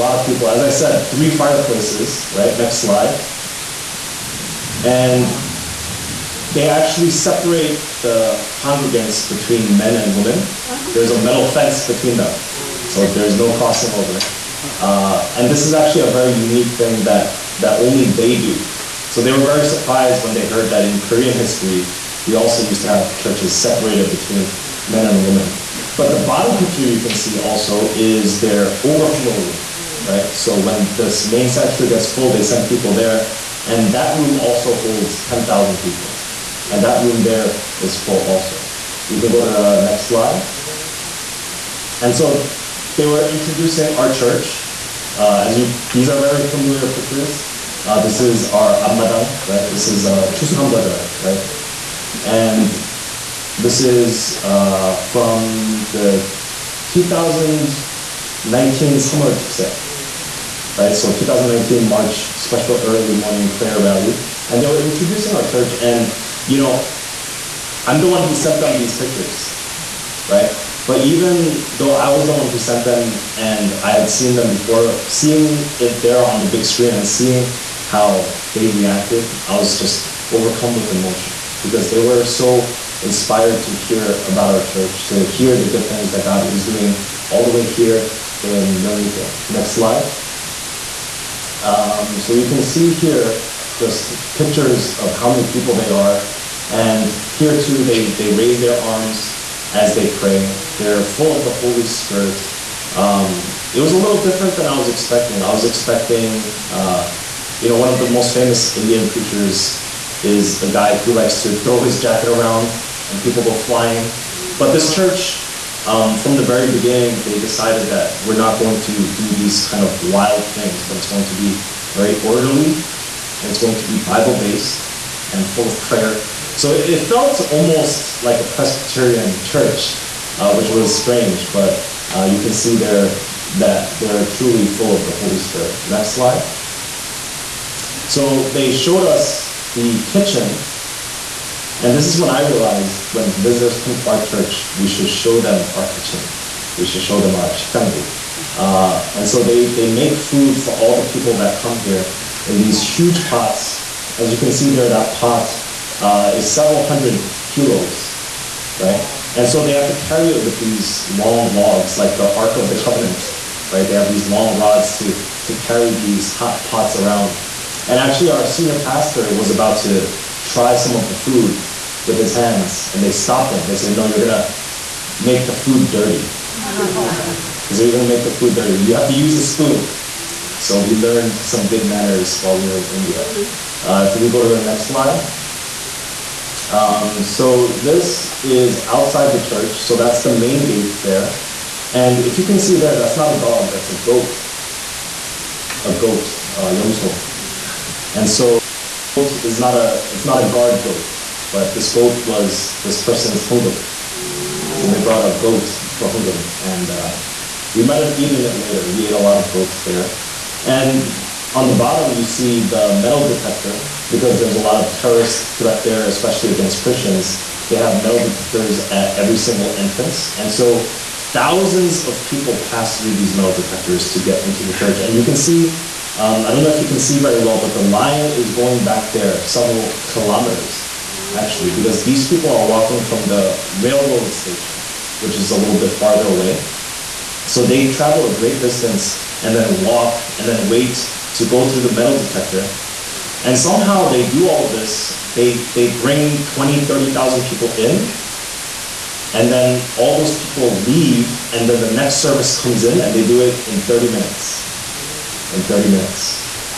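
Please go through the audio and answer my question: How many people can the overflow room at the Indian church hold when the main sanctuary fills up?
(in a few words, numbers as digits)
10,000.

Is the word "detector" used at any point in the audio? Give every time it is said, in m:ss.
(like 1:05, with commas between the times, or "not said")
3:33, 3:38, 3:43, 4:02.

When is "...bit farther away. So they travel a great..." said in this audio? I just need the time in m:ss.
3:55.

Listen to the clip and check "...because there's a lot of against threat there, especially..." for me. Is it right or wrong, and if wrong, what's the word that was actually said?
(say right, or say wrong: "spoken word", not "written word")
wrong: "terrorist", not "against".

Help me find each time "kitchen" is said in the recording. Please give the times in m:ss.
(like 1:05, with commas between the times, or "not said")
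2:20, 2:25.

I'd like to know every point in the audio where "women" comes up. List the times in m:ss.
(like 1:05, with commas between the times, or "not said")
0:10, 0:25.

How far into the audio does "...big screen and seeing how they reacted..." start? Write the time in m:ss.
1:16.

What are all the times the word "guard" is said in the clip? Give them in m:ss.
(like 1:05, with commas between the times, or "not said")
3:20.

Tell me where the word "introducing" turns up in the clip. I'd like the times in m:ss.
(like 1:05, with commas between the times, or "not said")
0:43, 1:04.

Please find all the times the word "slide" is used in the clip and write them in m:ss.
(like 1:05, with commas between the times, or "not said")
0:02, 0:40, 1:29, 2:16, 3:04.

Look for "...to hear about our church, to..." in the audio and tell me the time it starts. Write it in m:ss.
1:23.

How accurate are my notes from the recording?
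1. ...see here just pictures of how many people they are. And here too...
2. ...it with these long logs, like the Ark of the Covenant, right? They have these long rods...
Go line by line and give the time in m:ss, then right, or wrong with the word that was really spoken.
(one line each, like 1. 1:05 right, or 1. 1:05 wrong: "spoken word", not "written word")
1. 1:32 right
2. 2:40 right.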